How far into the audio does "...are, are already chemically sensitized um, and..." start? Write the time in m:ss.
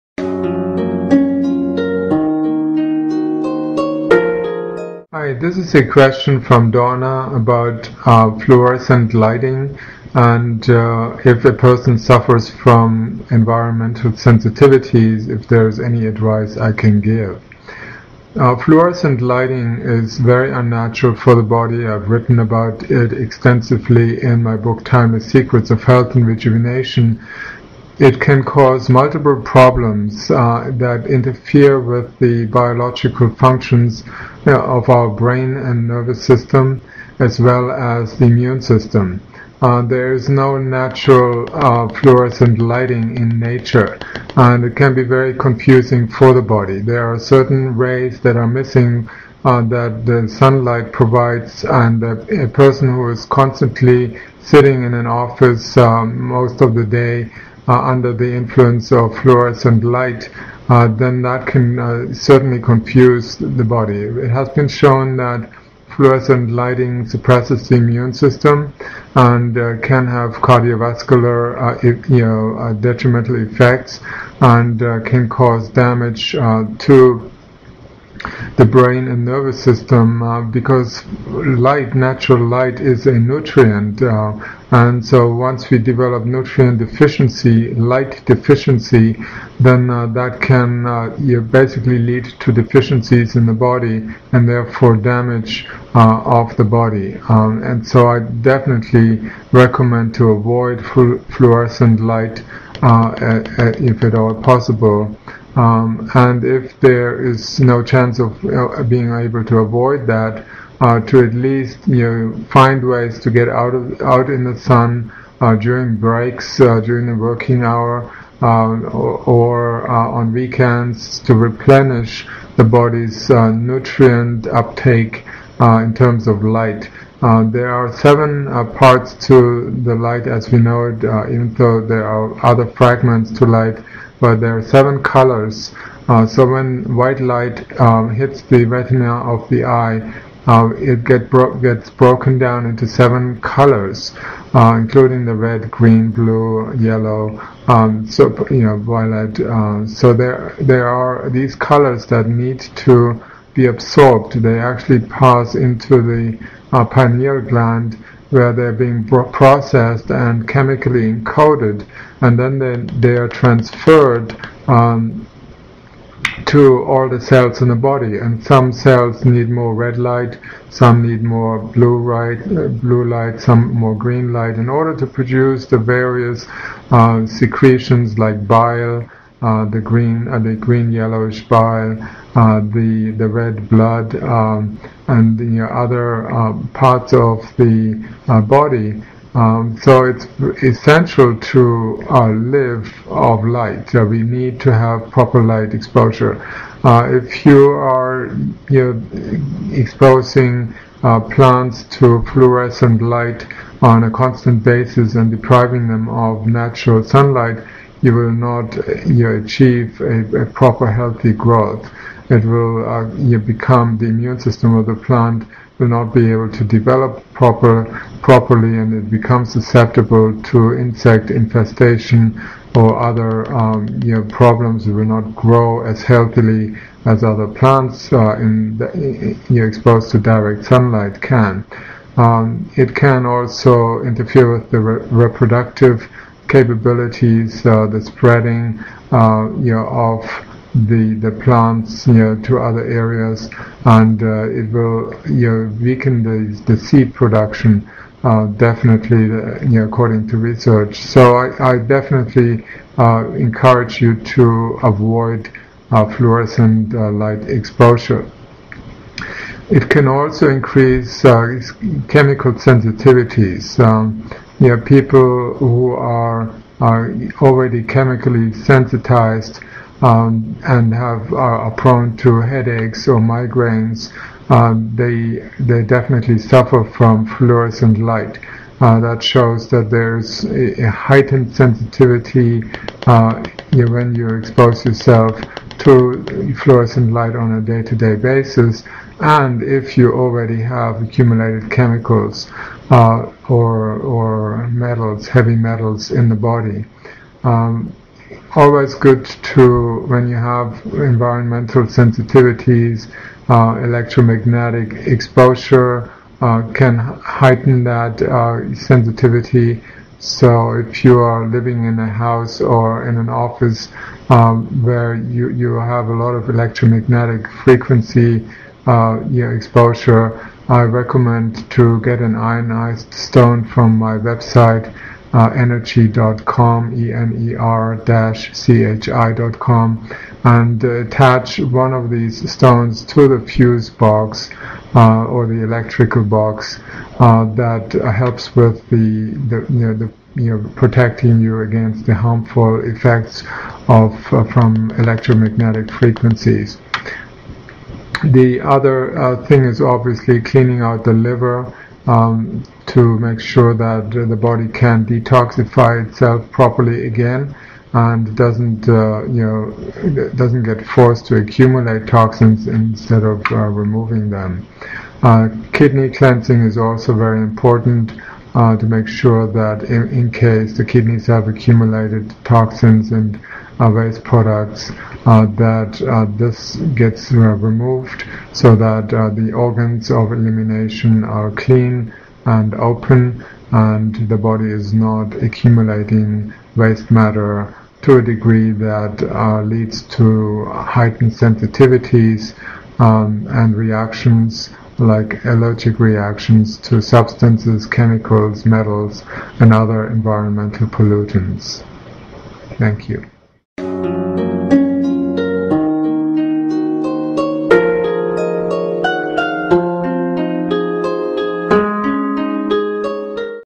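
4:25.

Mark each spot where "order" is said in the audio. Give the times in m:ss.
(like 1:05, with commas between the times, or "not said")
2:54.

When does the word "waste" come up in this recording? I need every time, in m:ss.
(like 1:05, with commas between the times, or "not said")
6:13, 6:26.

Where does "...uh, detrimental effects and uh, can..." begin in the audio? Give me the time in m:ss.
1:12.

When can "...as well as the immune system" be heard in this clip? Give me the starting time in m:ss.
0:37.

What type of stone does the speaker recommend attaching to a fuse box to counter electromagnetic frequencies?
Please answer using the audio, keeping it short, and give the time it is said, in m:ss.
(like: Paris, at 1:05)
ionized stone, at 5:22.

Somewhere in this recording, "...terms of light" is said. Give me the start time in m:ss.
2:05.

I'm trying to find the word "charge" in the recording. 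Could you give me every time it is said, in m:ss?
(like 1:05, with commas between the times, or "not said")
not said.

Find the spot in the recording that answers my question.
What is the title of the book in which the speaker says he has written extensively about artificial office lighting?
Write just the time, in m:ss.
0:24.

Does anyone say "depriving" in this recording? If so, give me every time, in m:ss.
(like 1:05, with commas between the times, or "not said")
3:25.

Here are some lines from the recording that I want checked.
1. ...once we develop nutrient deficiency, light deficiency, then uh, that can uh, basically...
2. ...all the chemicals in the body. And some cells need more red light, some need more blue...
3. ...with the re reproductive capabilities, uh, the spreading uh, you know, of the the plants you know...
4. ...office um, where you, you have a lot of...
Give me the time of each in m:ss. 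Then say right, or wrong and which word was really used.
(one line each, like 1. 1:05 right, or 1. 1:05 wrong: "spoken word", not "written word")
1. 1:25 right
2. 2:46 wrong: "cells", not "chemicals"
3. 3:54 right
4. 5:13 right.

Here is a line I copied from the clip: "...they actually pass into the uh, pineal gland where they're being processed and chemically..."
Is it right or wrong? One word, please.
right.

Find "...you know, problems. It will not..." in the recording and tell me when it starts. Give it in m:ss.
3:44.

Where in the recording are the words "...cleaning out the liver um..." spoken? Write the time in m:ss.
5:50.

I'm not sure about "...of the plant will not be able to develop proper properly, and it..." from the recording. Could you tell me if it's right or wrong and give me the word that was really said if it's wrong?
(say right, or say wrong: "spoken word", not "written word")
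right.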